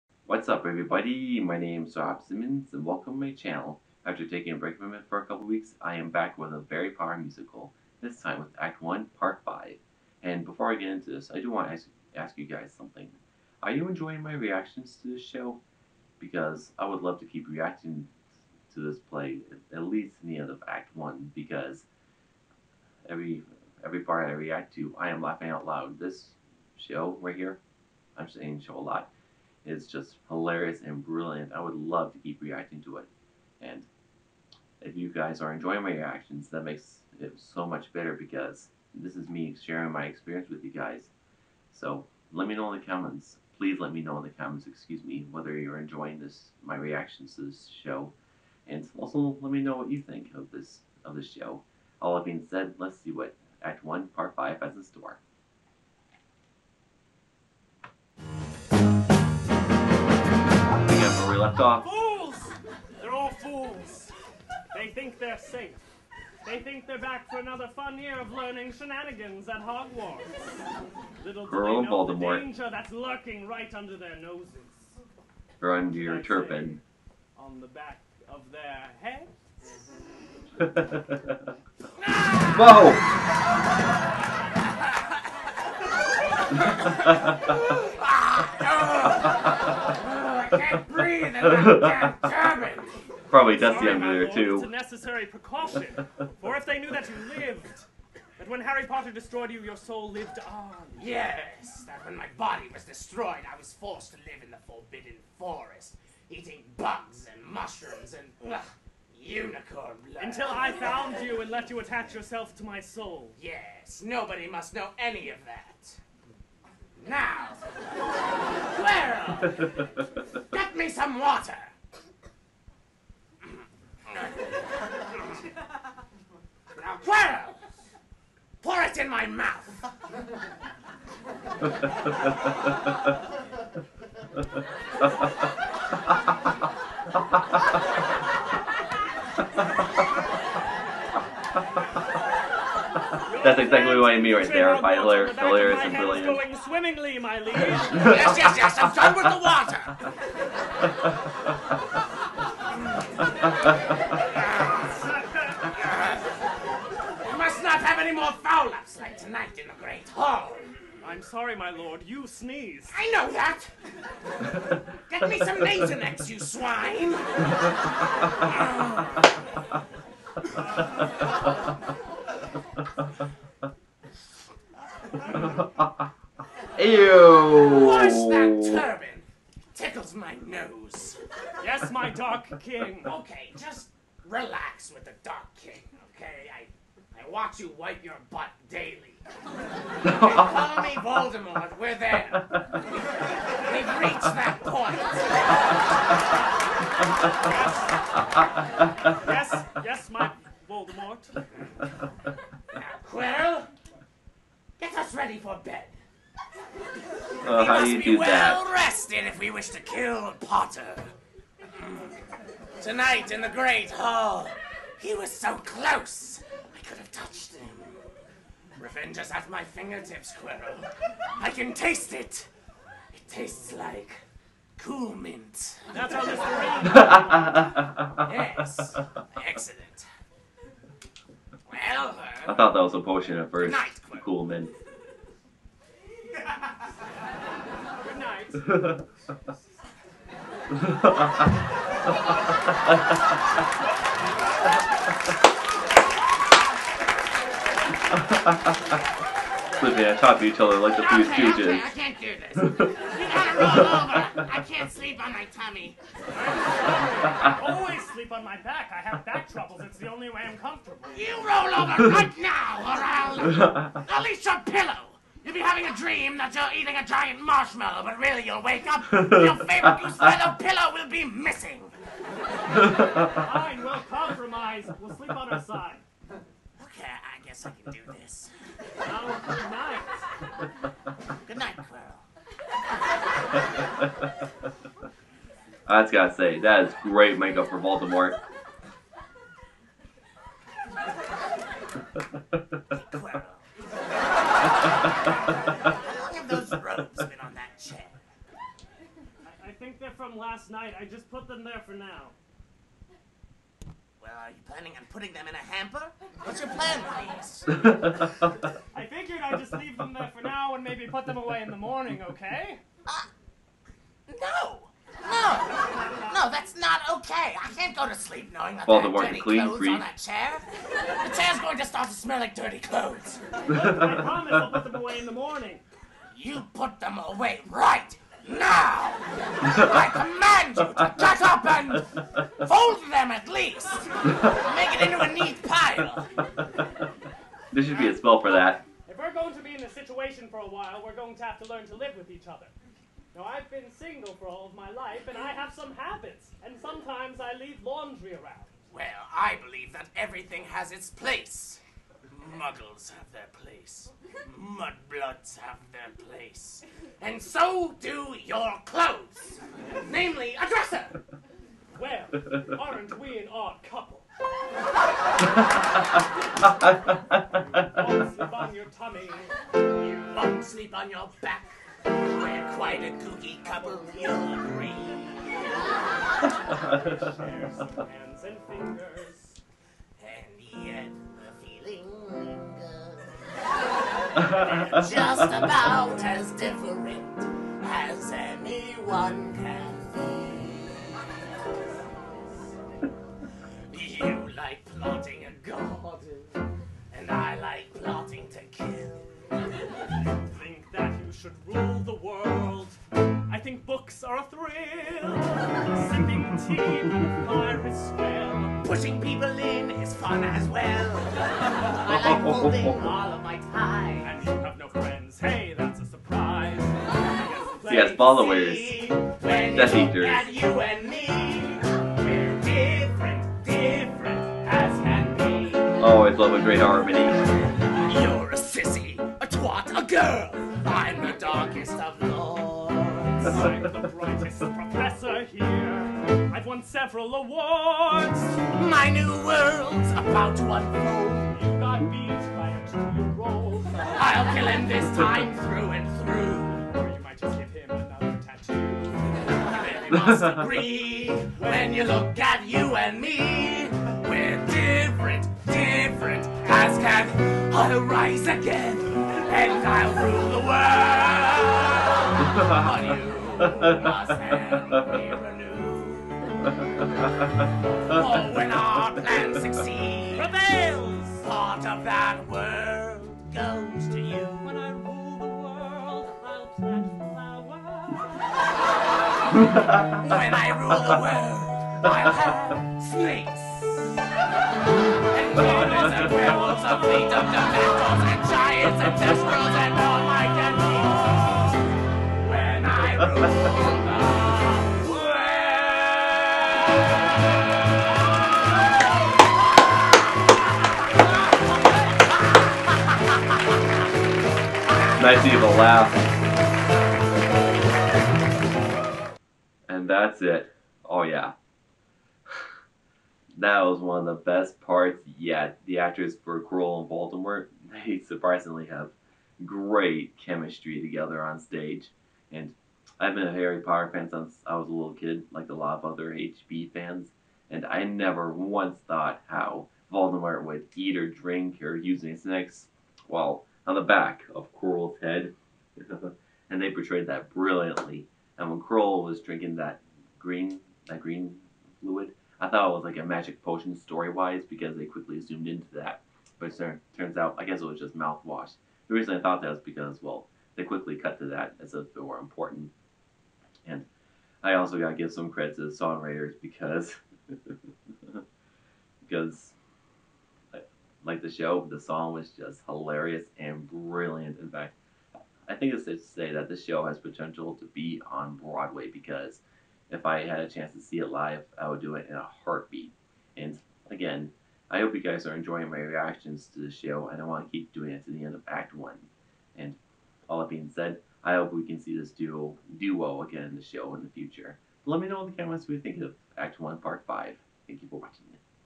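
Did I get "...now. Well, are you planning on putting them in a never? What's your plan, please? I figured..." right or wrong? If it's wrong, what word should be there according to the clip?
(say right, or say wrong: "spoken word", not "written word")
wrong: "hamper", not "never".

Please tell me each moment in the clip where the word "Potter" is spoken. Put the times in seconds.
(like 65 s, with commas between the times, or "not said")
6 s, 98 s, 210 s, 523 s.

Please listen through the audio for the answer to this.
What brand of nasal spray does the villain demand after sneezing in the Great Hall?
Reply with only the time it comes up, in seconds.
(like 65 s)
165 s.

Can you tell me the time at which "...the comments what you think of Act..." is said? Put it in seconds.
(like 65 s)
585 s.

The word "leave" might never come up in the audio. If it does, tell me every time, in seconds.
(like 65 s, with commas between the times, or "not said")
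309 s, 347 s.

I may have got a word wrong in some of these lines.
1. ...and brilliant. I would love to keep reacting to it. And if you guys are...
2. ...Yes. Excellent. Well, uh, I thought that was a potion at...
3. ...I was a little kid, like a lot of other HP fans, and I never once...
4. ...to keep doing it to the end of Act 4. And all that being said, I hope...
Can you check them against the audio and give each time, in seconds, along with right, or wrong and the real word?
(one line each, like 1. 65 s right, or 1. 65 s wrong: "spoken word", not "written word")
1. 30 s right
2. 228 s right
3. 524 s right
4. 577 s wrong: "1", not "4".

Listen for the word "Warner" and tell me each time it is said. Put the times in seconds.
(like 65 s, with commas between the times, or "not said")
not said.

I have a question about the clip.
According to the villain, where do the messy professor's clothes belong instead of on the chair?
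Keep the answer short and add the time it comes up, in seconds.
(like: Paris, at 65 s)
A dresser, at 360 s.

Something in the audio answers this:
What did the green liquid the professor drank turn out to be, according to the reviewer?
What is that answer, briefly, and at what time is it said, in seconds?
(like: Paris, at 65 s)
Mouthwash, at 548 s.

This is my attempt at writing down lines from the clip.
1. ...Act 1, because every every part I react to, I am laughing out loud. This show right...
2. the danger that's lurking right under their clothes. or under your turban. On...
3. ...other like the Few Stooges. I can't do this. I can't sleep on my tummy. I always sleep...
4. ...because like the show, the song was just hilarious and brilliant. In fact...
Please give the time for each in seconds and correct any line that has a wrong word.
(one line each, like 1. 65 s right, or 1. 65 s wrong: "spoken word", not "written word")
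1. 20 s right
2. 72 s wrong: "noses", not "clothes"
3. 250 s right
4. 559 s right.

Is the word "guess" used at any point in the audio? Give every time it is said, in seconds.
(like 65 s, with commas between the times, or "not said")
277 s, 547 s.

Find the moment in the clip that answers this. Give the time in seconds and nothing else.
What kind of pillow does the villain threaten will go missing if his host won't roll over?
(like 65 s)
270 s.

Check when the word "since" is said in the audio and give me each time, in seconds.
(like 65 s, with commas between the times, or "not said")
524 s.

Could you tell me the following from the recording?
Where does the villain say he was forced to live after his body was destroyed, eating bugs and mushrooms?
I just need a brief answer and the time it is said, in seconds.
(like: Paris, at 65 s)
Forbidden Forest, at 104 s.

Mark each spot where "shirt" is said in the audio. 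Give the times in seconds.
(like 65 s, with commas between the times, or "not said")
not said.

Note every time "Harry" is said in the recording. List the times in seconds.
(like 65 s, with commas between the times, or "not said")
98 s, 523 s.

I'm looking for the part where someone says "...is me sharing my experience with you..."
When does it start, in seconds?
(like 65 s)
39 s.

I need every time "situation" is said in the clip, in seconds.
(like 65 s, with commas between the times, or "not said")
339 s.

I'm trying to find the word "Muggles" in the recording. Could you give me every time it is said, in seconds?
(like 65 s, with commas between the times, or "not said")
352 s.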